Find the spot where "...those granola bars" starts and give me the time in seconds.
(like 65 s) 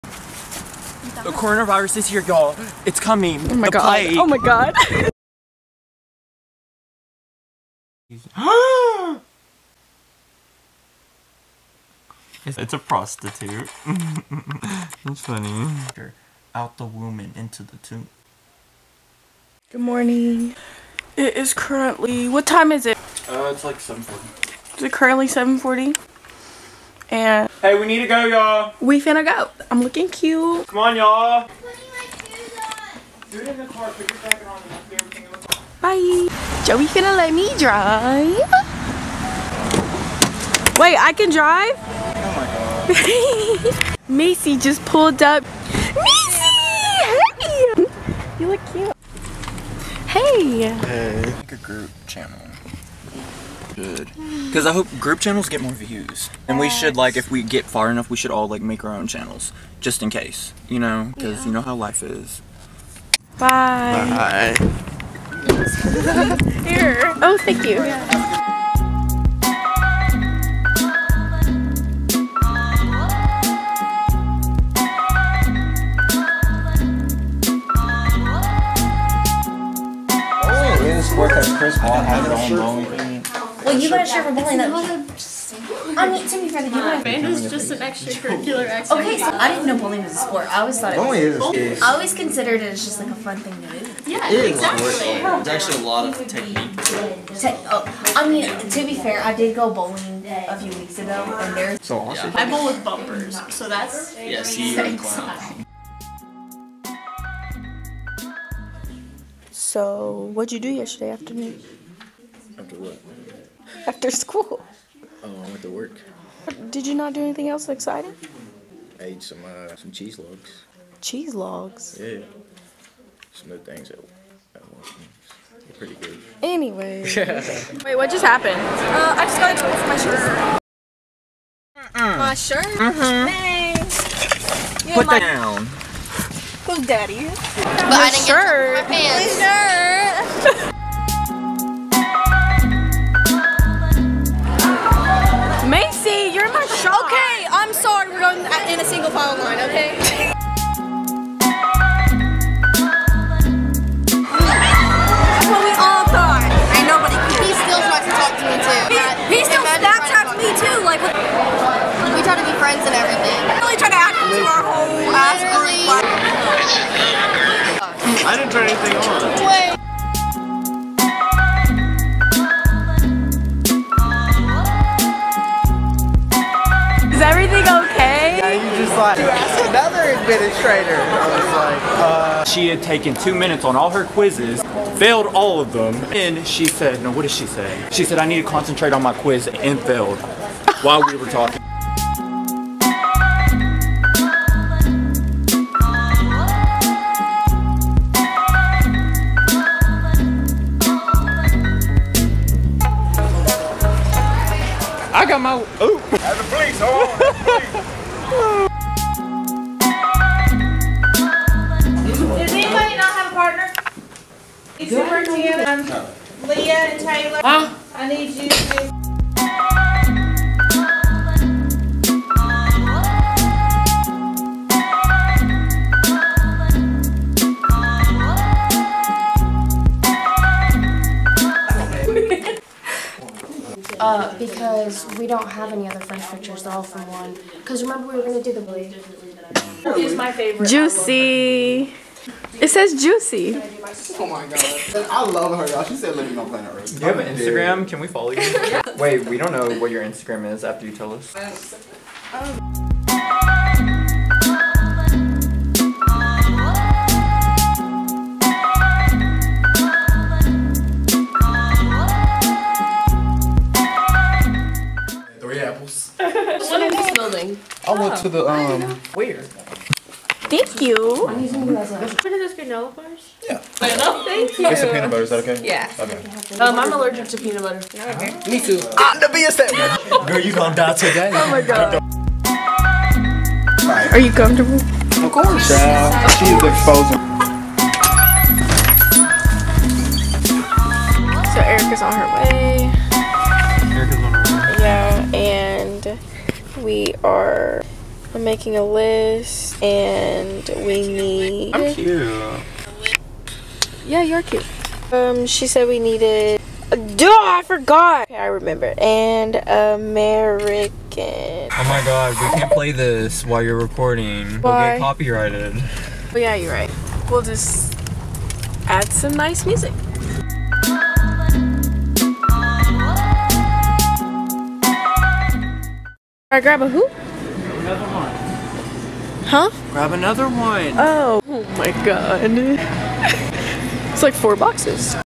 272 s.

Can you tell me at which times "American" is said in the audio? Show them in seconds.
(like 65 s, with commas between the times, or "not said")
309 s.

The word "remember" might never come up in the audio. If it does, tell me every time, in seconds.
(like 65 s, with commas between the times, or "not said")
237 s, 308 s.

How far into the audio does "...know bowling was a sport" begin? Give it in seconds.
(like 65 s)
89 s.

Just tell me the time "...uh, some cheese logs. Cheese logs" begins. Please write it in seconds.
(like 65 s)
119 s.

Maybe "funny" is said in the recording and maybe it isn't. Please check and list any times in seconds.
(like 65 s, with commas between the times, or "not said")
15 s.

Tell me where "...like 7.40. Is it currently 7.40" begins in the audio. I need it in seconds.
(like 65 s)
23 s.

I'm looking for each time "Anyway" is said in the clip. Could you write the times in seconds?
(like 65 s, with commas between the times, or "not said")
126 s.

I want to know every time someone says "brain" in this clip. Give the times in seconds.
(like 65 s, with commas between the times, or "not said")
not said.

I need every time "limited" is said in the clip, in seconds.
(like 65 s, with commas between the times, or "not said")
not said.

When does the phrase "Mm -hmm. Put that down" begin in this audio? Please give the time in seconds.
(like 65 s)
132 s.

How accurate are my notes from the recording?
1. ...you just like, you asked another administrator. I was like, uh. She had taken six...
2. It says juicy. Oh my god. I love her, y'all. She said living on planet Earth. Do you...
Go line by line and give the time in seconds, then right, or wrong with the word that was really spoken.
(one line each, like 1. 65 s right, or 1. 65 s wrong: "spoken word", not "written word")
1. 178 s wrong: "two", not "six"
2. 242 s right.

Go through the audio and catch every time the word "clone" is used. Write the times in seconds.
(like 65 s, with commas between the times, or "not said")
not said.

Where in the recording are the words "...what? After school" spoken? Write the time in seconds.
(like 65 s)
112 s.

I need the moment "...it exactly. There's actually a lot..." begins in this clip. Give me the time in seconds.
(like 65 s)
94 s.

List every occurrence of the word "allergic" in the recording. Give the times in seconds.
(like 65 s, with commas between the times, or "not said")
276 s.